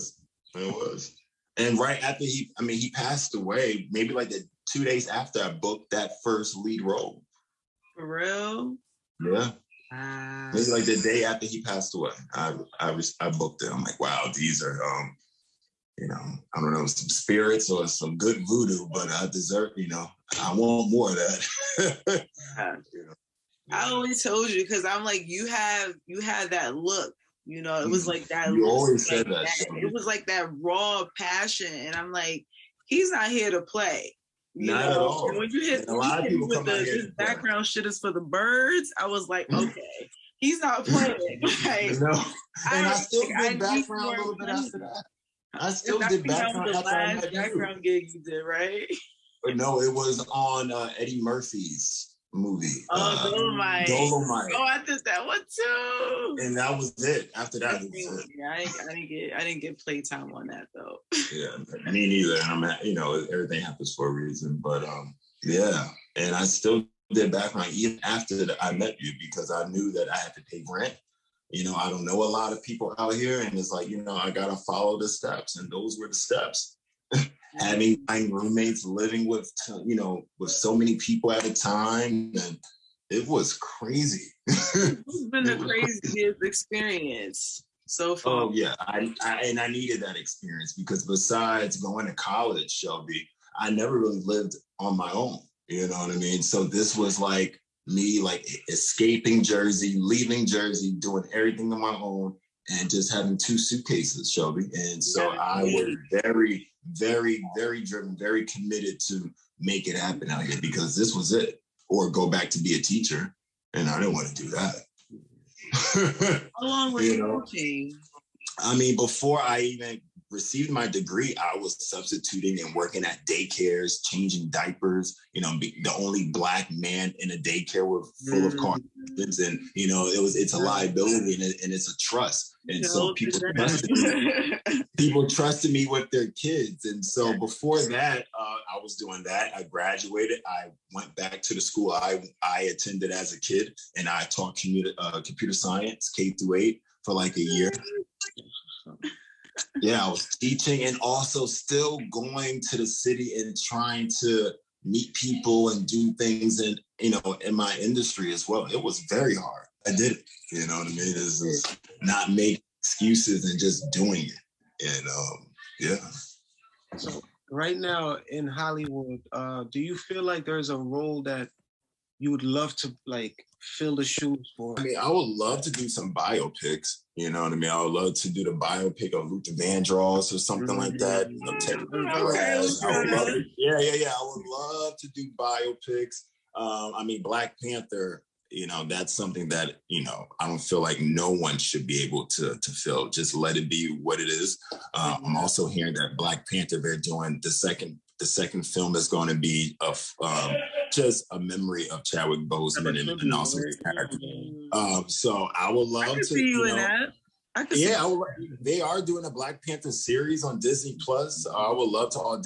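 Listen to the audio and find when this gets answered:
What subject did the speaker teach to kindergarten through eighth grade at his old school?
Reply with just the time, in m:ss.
2:25.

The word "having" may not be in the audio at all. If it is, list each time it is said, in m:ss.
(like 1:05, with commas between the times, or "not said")
1:17, 1:43.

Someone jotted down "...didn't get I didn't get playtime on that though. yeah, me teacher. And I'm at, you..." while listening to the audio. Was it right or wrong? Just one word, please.
wrong.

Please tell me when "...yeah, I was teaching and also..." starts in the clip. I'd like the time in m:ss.
2:29.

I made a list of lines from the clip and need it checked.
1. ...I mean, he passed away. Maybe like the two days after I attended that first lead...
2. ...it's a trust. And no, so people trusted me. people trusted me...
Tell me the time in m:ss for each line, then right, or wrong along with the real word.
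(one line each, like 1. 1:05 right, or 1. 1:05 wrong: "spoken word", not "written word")
1. 0:02 wrong: "booked", not "attended"
2. 2:11 right.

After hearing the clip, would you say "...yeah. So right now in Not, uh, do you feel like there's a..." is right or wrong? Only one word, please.
wrong.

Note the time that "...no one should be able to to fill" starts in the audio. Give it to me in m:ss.
3:10.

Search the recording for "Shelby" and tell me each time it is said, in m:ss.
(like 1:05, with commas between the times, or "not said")
1:32, 1:44.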